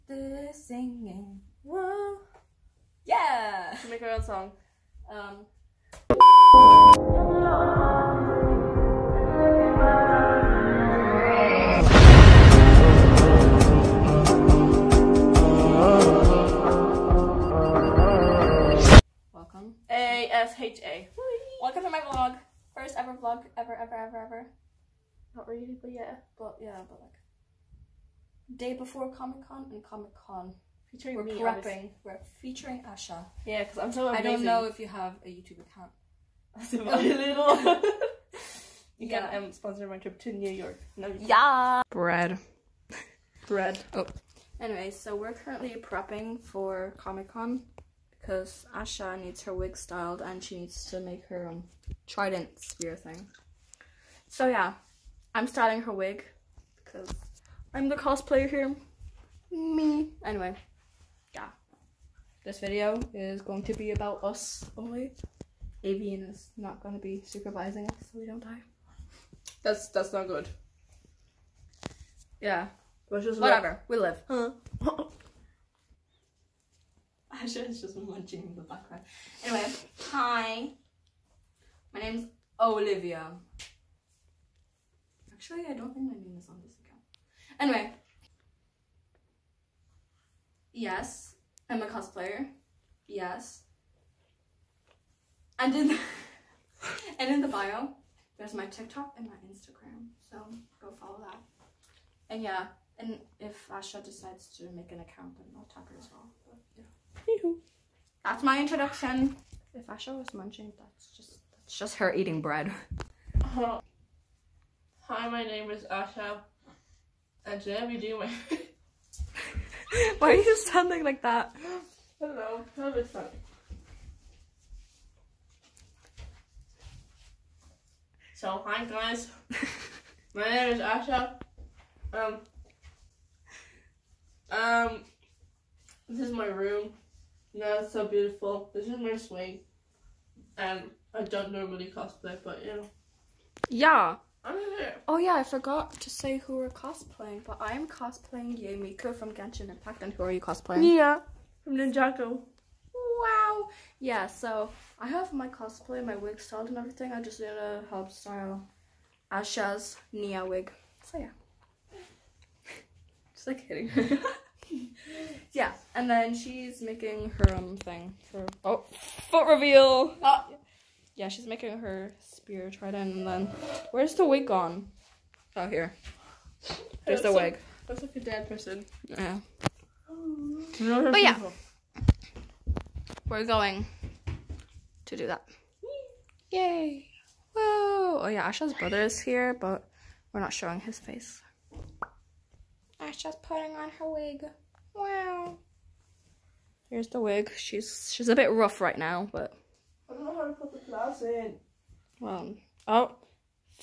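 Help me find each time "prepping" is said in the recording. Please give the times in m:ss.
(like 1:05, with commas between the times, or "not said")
0:31, 0:45.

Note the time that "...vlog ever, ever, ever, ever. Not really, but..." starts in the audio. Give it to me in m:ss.
0:23.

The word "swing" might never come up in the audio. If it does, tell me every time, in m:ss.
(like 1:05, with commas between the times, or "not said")
2:19.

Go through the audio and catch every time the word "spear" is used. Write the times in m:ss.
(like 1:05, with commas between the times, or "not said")
0:52, 2:52.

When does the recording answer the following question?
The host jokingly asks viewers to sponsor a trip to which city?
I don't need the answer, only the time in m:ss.
0:40.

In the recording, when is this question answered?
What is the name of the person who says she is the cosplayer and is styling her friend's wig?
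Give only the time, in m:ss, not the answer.
1:22.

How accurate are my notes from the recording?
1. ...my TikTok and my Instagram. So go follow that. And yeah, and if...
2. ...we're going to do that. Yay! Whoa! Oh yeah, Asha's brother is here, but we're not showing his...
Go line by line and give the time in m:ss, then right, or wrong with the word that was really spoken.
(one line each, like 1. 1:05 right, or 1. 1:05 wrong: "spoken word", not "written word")
1. 1:38 right
2. 3:03 right.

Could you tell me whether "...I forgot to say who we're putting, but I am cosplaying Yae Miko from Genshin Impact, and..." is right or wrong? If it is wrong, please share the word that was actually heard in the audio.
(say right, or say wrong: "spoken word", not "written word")
wrong: "cosplaying", not "putting".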